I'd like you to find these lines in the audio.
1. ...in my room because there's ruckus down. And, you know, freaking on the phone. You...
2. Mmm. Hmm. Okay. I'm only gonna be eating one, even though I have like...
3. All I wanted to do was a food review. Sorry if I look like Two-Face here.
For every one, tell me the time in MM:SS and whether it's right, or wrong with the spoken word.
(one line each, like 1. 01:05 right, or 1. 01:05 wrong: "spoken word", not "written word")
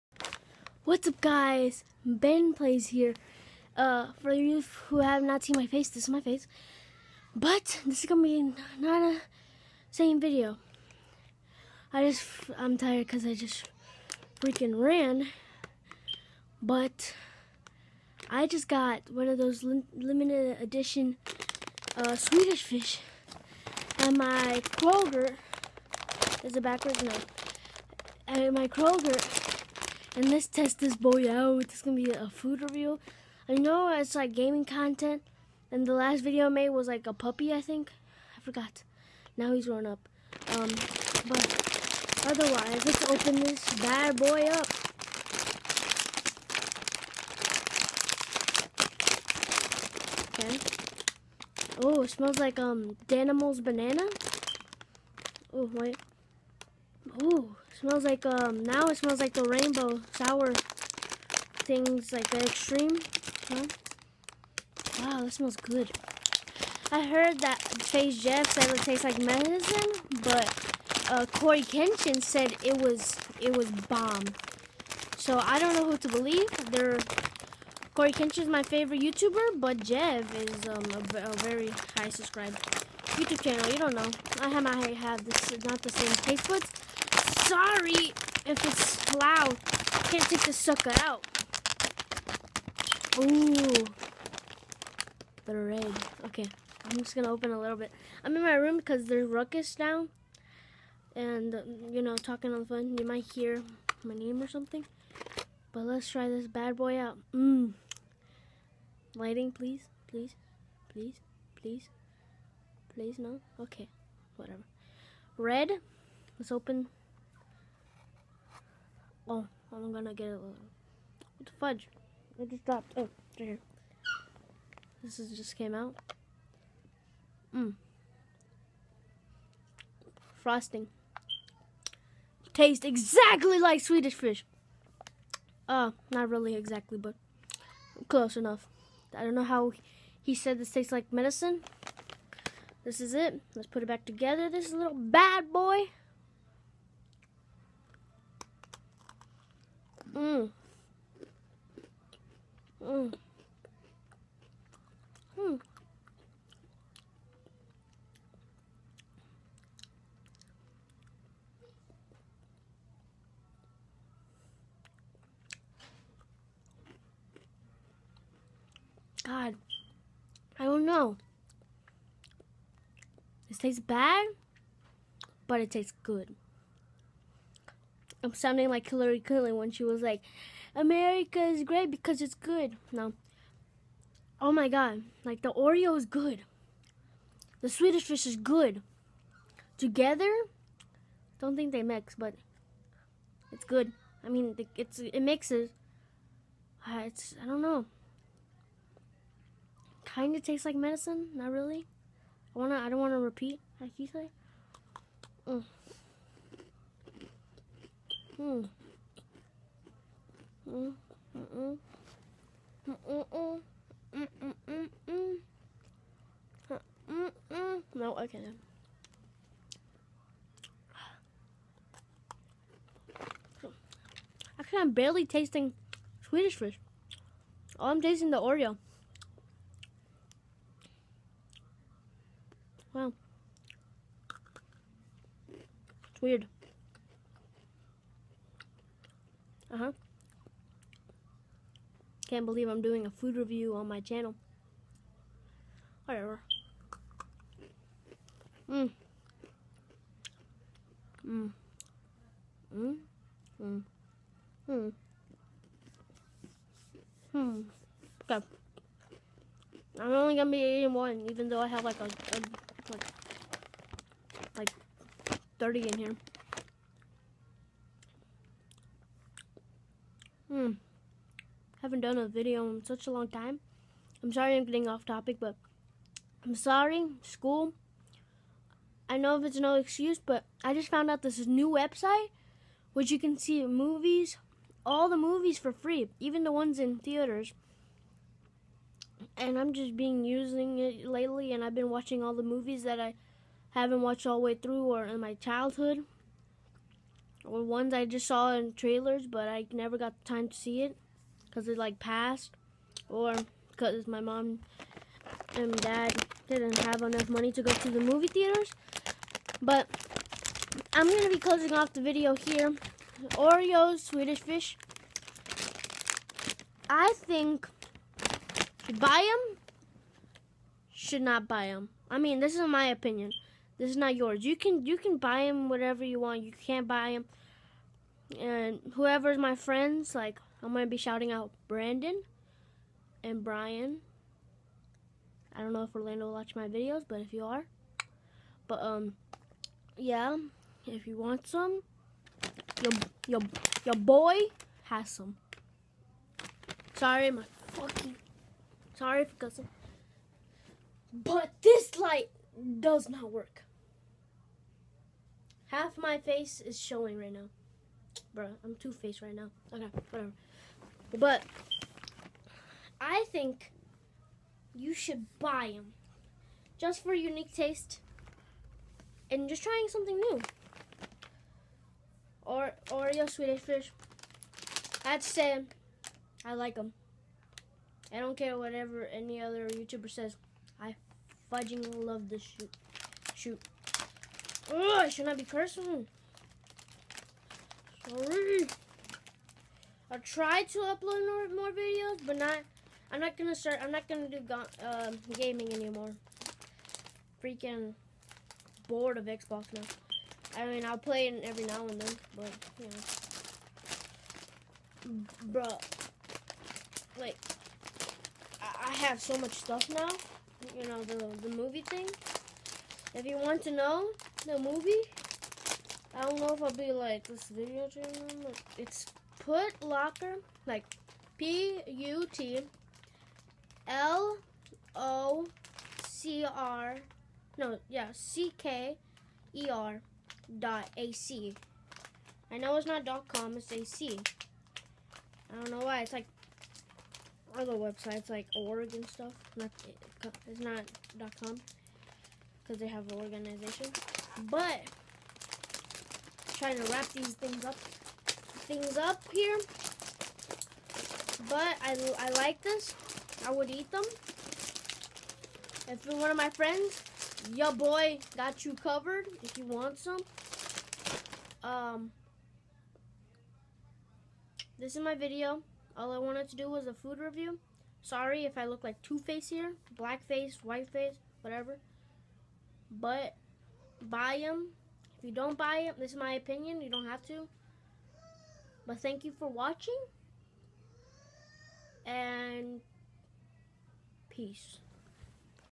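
1. 01:38 wrong: "talking", not "freaking"
2. 04:14 right
3. 07:45 right.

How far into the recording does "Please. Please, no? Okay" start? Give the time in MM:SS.
01:51.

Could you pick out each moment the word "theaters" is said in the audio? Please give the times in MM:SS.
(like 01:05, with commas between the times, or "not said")
04:46, 05:08.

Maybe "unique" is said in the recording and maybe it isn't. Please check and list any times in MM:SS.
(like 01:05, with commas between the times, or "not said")
06:07.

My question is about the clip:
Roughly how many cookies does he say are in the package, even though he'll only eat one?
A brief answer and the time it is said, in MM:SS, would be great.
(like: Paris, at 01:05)
30, at 04:25.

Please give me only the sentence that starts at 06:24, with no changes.
Oh, I should not be cursing.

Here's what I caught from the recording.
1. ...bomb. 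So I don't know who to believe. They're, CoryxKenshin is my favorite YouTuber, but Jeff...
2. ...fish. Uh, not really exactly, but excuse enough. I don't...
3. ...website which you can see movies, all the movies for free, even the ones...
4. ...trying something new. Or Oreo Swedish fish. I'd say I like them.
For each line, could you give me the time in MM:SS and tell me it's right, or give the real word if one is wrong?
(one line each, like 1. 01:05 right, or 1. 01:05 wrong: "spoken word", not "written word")
1. 01:13 right
2. 02:14 wrong: "close", not "excuse"
3. 04:41 right
4. 06:09 right.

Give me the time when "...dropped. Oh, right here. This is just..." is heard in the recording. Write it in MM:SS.
02:02.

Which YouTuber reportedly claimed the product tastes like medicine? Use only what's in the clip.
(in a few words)
Space Jeff.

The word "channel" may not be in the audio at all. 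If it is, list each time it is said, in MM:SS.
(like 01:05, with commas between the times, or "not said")
01:23, 04:04, 06:57.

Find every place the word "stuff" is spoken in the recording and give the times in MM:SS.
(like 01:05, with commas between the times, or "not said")
06:49, 07:19.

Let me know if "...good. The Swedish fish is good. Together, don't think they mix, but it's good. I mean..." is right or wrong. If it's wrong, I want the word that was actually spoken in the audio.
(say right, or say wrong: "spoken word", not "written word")
right.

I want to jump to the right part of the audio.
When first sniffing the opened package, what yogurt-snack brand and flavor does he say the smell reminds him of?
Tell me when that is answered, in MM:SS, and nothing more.
00:53.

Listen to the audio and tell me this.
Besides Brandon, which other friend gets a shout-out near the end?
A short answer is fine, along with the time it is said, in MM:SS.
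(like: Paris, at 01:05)
Brian, at 05:33.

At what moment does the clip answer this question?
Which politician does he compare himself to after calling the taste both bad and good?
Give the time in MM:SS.
02:58.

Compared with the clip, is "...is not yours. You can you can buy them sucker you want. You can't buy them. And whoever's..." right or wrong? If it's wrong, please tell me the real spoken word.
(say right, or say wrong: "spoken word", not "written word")
wrong: "whatever", not "sucker".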